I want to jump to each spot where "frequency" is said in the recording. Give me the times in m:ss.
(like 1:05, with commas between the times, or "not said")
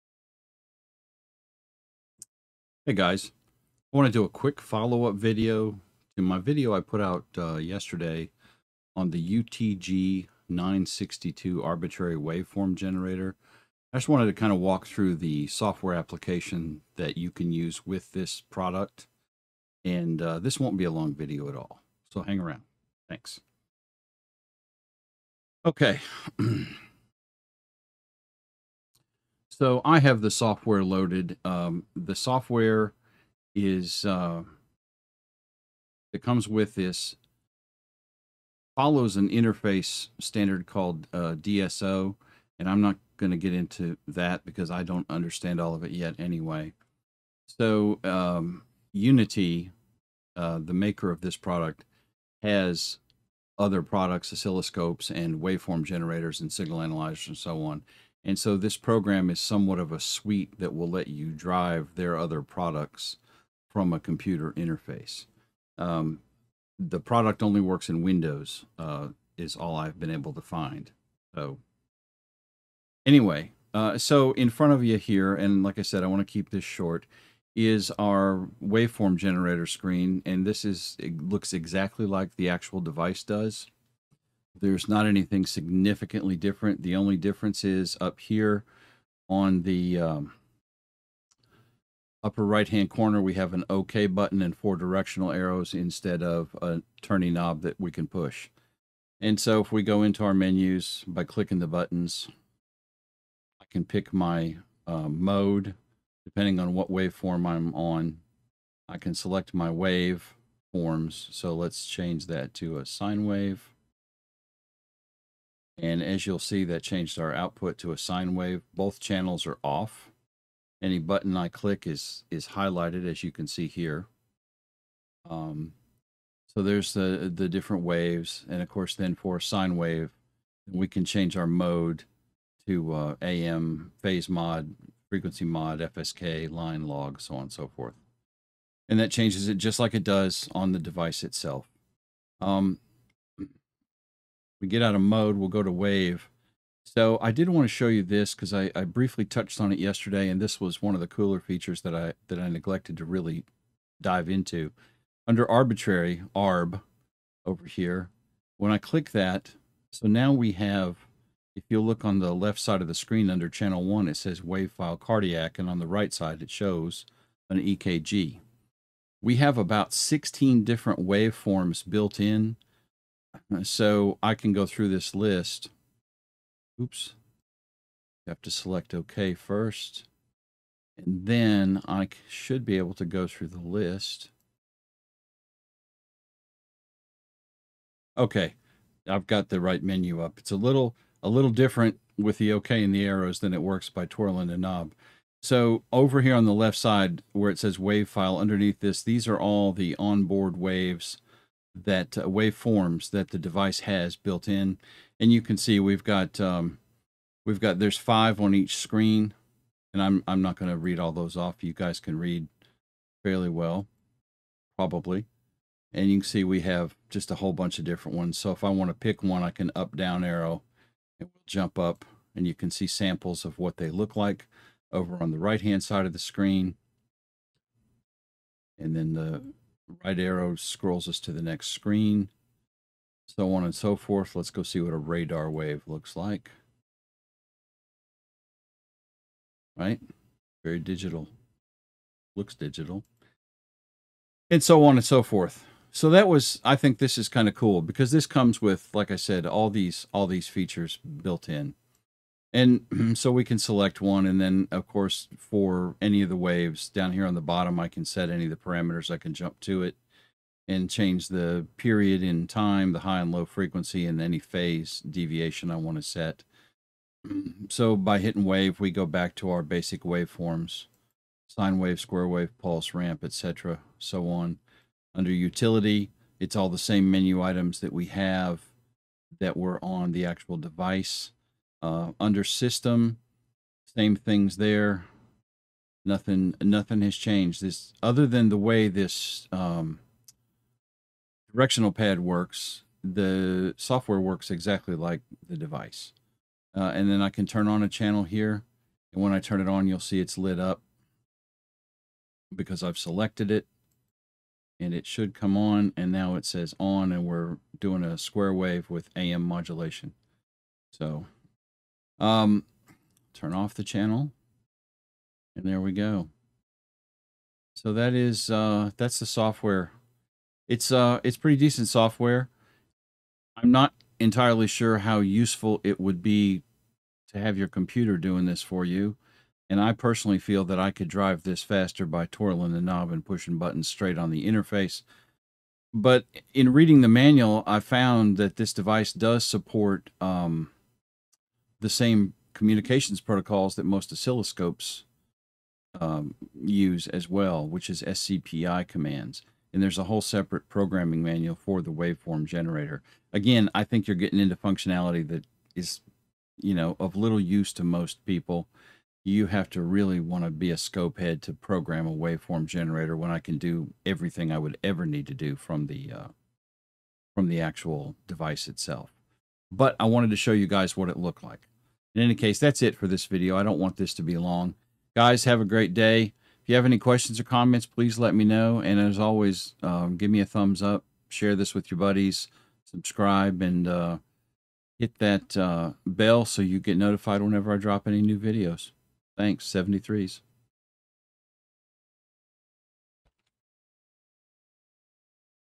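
2:15, 4:23.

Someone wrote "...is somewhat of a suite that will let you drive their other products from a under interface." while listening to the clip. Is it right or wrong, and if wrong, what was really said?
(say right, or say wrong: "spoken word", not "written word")
wrong: "computer", not "under".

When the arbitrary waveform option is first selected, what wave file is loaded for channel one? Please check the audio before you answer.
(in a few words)
Cardiac.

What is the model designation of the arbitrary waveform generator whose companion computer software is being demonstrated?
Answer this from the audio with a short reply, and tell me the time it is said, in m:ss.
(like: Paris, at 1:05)
UTG 962, at 0:09.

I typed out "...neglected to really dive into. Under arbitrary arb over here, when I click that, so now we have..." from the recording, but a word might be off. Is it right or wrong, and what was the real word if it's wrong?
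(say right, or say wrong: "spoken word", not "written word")
right.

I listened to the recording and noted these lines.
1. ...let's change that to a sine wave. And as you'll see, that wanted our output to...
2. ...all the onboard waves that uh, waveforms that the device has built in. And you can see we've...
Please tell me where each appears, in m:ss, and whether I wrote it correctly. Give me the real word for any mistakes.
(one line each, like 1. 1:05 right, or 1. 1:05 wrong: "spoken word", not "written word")
1. 1:51 wrong: "changed", not "wanted"
2. 3:19 right.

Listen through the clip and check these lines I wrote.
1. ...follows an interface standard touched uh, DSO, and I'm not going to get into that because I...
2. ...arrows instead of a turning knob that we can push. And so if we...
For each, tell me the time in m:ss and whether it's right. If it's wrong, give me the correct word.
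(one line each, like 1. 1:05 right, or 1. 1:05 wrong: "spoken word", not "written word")
1. 0:38 wrong: "called", not "touched"
2. 1:35 right.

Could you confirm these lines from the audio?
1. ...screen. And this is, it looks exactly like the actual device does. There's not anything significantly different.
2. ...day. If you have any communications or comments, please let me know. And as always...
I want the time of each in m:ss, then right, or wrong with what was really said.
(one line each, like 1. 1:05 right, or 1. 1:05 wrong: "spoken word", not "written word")
1. 1:19 right
2. 6:15 wrong: "questions", not "communications".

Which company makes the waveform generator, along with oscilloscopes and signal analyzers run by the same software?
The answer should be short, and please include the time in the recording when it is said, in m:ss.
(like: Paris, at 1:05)
UNI-T, at 0:48.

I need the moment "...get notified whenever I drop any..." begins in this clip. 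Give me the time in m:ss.
6:26.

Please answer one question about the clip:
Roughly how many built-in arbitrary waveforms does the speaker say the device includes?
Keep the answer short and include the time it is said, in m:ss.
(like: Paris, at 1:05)
16, at 2:49.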